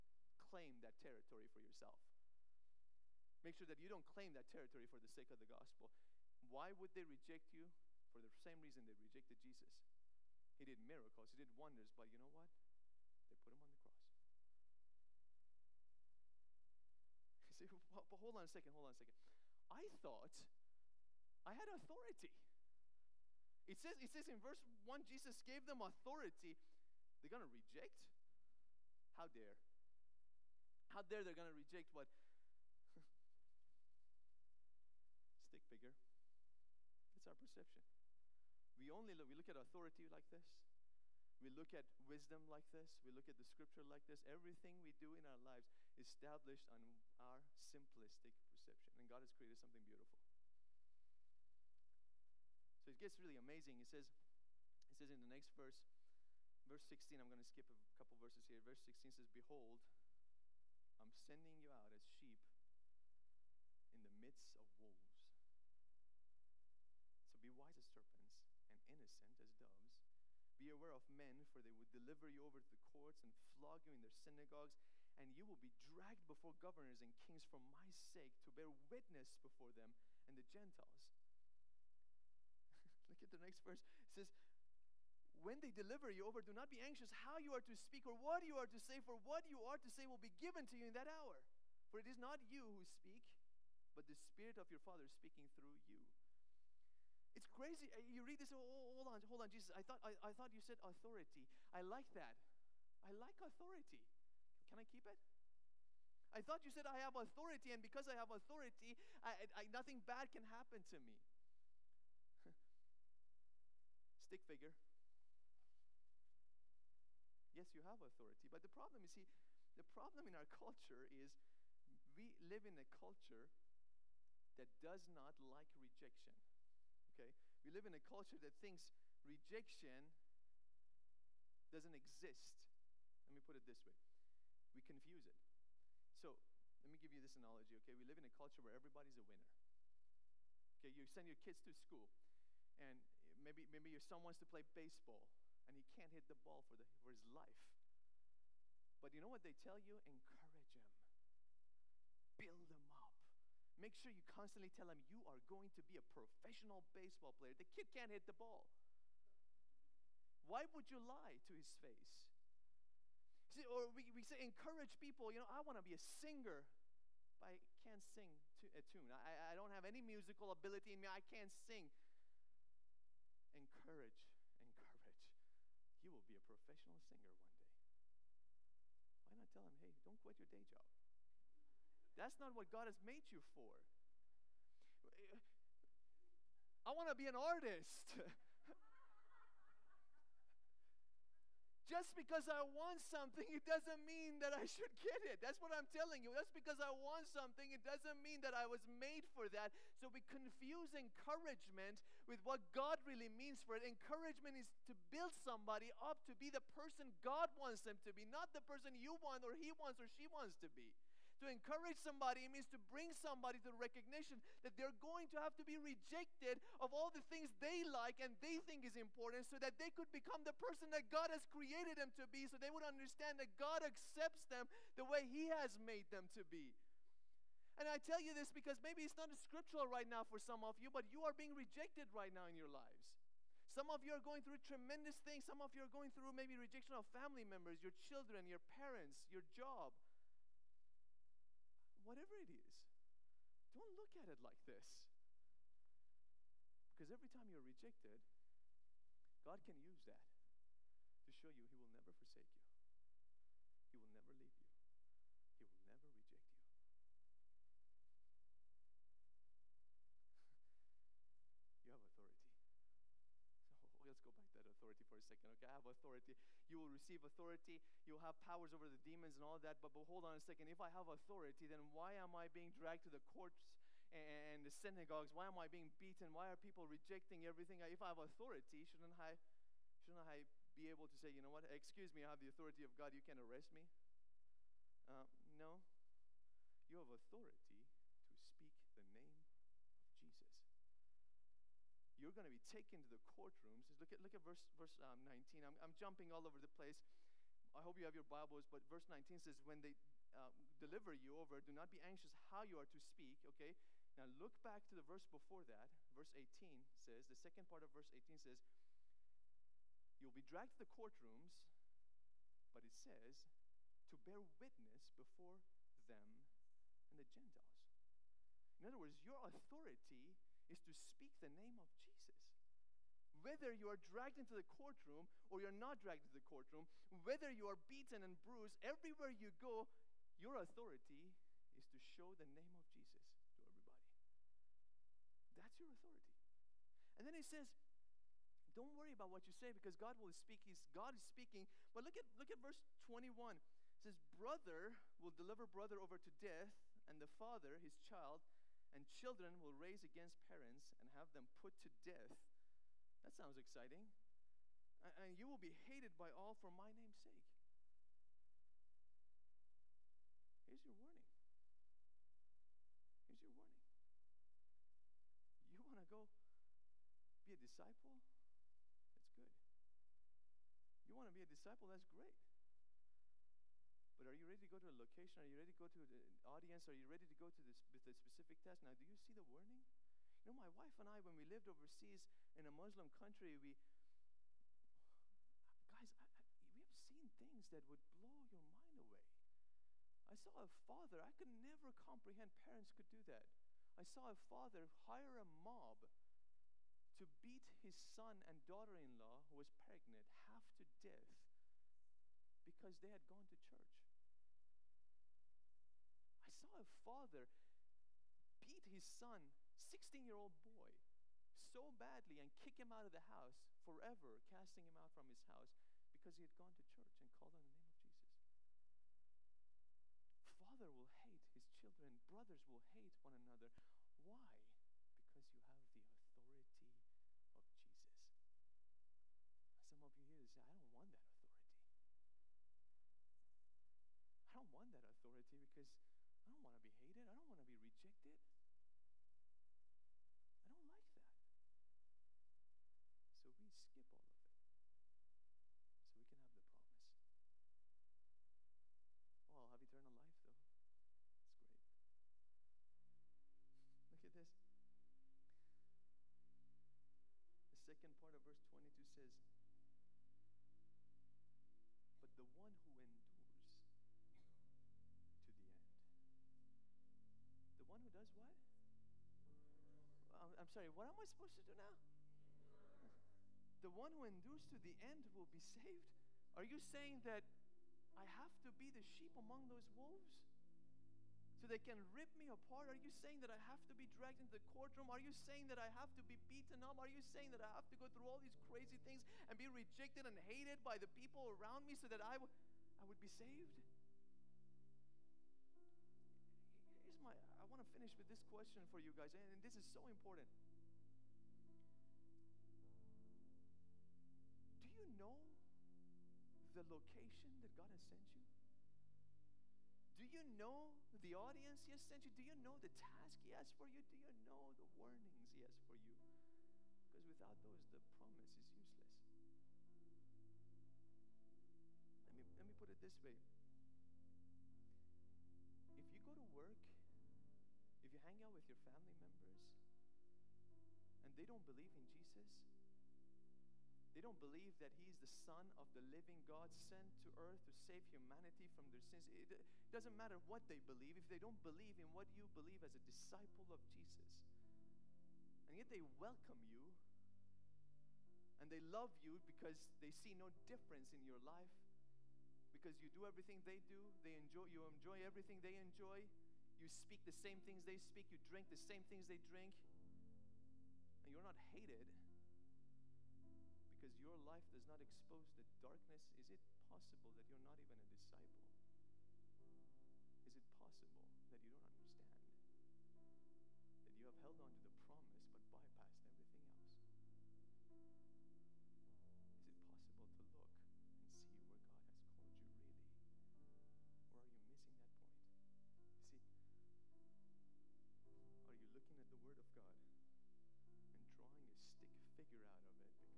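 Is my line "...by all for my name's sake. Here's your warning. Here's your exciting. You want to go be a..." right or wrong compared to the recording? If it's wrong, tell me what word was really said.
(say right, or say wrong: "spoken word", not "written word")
wrong: "warning", not "exciting".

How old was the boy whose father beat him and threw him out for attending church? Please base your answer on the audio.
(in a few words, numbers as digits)
16.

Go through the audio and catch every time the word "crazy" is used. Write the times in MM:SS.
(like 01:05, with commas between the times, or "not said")
01:37, 08:08.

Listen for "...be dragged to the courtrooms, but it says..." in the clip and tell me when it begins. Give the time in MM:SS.
05:10.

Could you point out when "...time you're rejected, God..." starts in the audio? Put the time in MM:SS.
04:07.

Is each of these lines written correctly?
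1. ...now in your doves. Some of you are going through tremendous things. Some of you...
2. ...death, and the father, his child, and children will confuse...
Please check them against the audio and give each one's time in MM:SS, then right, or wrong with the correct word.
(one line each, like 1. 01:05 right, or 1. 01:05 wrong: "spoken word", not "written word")
1. 03:52 wrong: "lives", not "doves"
2. 05:46 wrong: "raise", not "confuse".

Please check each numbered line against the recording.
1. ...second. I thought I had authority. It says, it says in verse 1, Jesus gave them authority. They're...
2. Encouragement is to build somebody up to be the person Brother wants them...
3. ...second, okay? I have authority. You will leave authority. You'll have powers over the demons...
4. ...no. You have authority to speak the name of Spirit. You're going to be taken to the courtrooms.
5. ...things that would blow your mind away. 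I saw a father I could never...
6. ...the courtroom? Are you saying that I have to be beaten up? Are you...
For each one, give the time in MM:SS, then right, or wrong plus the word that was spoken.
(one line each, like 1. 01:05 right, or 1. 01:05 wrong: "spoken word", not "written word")
1. 00:18 right
2. 03:23 wrong: "God", not "Brother"
3. 04:25 wrong: "receive", not "leave"
4. 04:45 wrong: "Jesus", not "Spirit"
5. 06:27 right
6. 08:04 right.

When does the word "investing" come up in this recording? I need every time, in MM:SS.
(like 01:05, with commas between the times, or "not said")
not said.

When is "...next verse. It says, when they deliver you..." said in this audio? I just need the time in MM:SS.
01:23.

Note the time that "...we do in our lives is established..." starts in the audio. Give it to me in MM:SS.
00:44.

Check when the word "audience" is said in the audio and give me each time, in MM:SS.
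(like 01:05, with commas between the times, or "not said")
06:16, 08:31.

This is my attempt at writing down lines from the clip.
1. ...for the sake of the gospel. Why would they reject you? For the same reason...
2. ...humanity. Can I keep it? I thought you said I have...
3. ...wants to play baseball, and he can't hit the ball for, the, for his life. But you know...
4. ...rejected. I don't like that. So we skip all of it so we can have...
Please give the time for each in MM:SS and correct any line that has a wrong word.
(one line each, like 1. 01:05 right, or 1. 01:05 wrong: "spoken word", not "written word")
1. 00:04 right
2. 01:43 wrong: "authority", not "humanity"
3. 02:24 right
4. 07:17 right.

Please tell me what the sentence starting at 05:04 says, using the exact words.
Now look back to the verse before that.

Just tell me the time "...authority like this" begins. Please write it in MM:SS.
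00:39.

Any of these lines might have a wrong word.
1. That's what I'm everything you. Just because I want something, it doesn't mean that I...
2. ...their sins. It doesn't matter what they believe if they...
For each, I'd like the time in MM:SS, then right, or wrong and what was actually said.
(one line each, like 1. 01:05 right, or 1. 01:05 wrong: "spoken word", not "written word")
1. 03:15 wrong: "telling", not "everything"
2. 08:58 right.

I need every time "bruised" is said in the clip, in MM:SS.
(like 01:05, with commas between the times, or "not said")
05:28.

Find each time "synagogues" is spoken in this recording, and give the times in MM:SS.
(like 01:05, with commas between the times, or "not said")
01:14, 04:34.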